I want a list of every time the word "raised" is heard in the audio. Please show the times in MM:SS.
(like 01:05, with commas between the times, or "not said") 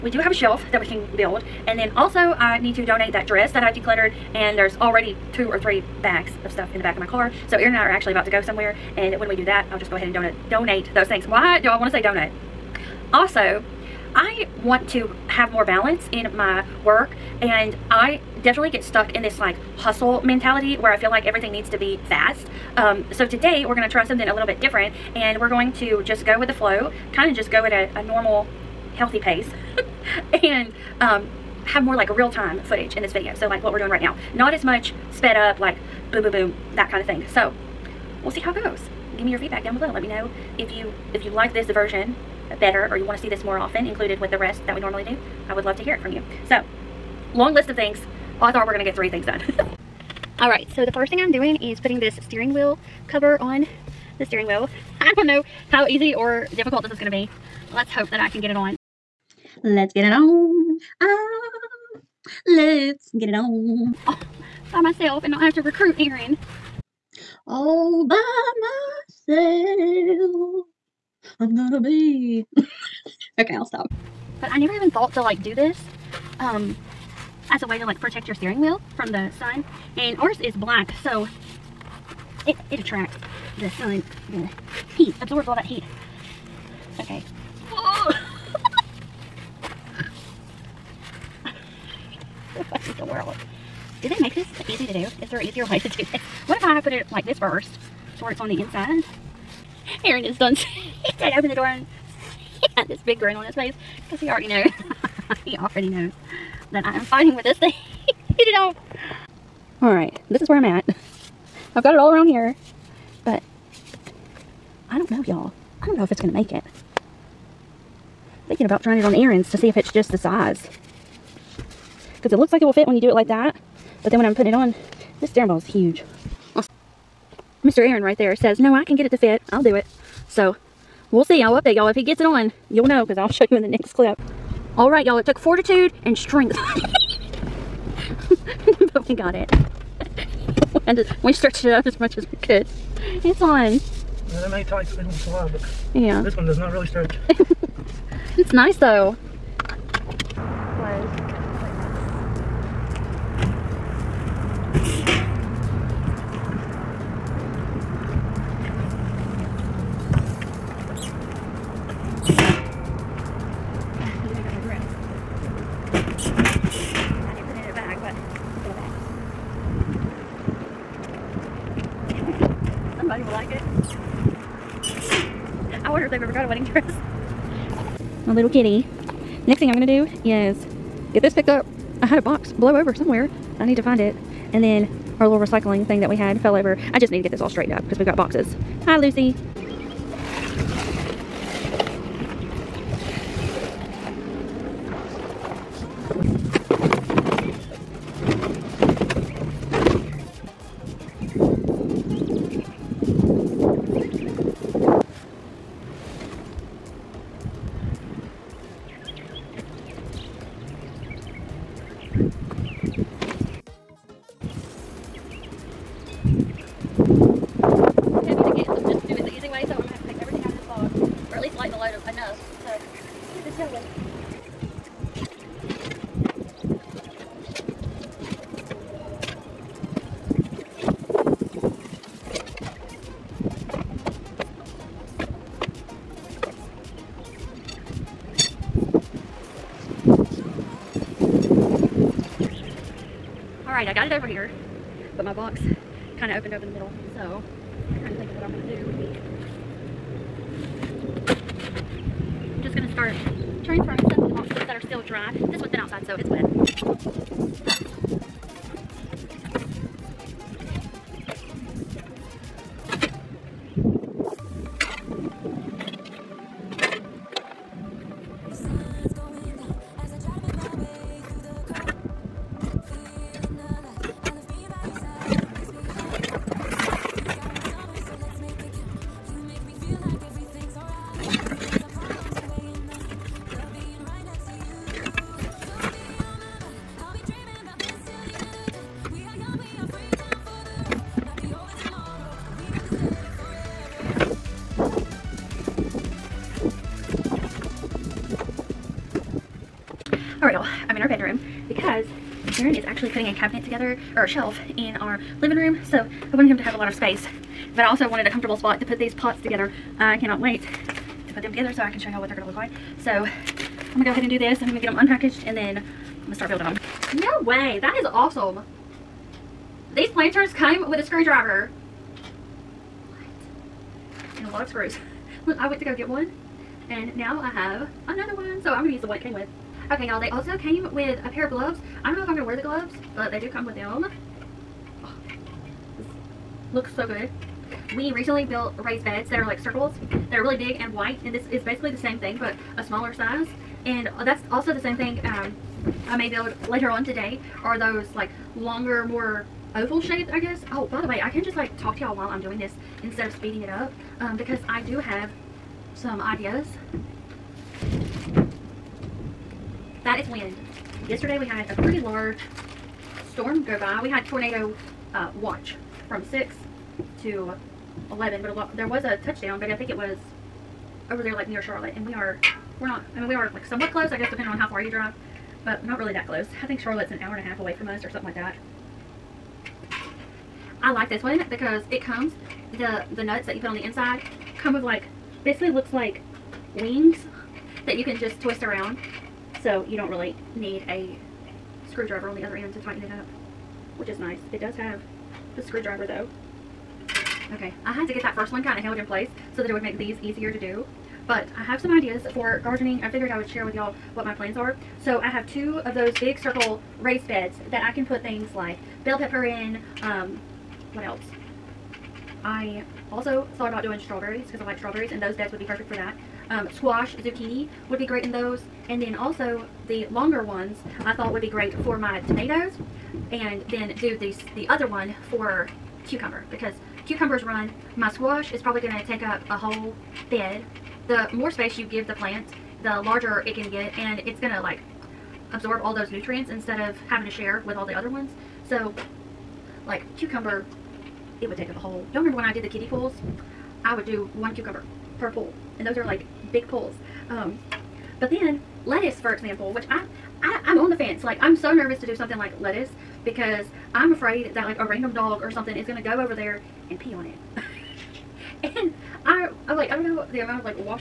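05:38, 06:47.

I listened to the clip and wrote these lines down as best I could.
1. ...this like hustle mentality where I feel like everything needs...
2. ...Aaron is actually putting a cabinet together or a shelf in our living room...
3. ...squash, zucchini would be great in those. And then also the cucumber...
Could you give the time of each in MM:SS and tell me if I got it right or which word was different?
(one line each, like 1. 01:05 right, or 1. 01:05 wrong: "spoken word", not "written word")
1. 00:19 right
2. 05:02 right
3. 06:56 wrong: "longer", not "cucumber".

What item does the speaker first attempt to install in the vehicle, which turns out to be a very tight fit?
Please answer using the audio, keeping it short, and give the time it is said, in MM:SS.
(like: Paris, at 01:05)
Steering wheel cover, at 00:52.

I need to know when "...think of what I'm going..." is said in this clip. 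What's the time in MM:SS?
04:08.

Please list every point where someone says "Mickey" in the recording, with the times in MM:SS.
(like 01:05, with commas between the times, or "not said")
not said.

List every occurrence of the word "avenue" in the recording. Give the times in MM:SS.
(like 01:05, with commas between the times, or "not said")
not said.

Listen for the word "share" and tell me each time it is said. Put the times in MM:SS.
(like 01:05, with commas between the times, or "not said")
06:43, 07:17.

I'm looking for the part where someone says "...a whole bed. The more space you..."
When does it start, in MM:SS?
07:09.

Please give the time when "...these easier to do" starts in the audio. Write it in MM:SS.
06:39.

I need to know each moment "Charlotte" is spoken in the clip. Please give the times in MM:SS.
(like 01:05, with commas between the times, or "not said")
06:11, 06:16.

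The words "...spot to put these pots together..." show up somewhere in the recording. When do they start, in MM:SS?
05:08.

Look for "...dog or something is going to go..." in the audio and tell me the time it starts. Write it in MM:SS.
07:35.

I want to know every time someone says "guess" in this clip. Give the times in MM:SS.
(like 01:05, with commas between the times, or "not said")
05:50, 06:14.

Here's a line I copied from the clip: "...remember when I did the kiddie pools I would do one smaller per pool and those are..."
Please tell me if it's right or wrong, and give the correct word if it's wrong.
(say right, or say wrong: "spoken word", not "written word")
wrong: "cucumber", not "smaller".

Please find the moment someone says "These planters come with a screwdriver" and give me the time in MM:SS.
05:19.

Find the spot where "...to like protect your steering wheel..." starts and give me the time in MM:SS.
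01:17.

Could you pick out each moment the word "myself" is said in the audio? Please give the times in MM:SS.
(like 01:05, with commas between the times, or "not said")
01:04, 01:09.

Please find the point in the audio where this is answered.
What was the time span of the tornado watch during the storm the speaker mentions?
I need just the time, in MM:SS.
06:06.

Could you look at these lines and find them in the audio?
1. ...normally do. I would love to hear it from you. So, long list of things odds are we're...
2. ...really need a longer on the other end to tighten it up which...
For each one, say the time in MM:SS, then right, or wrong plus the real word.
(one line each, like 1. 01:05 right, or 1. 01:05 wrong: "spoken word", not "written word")
1. 00:44 right
2. 06:30 wrong: "screwdriver", not "longer".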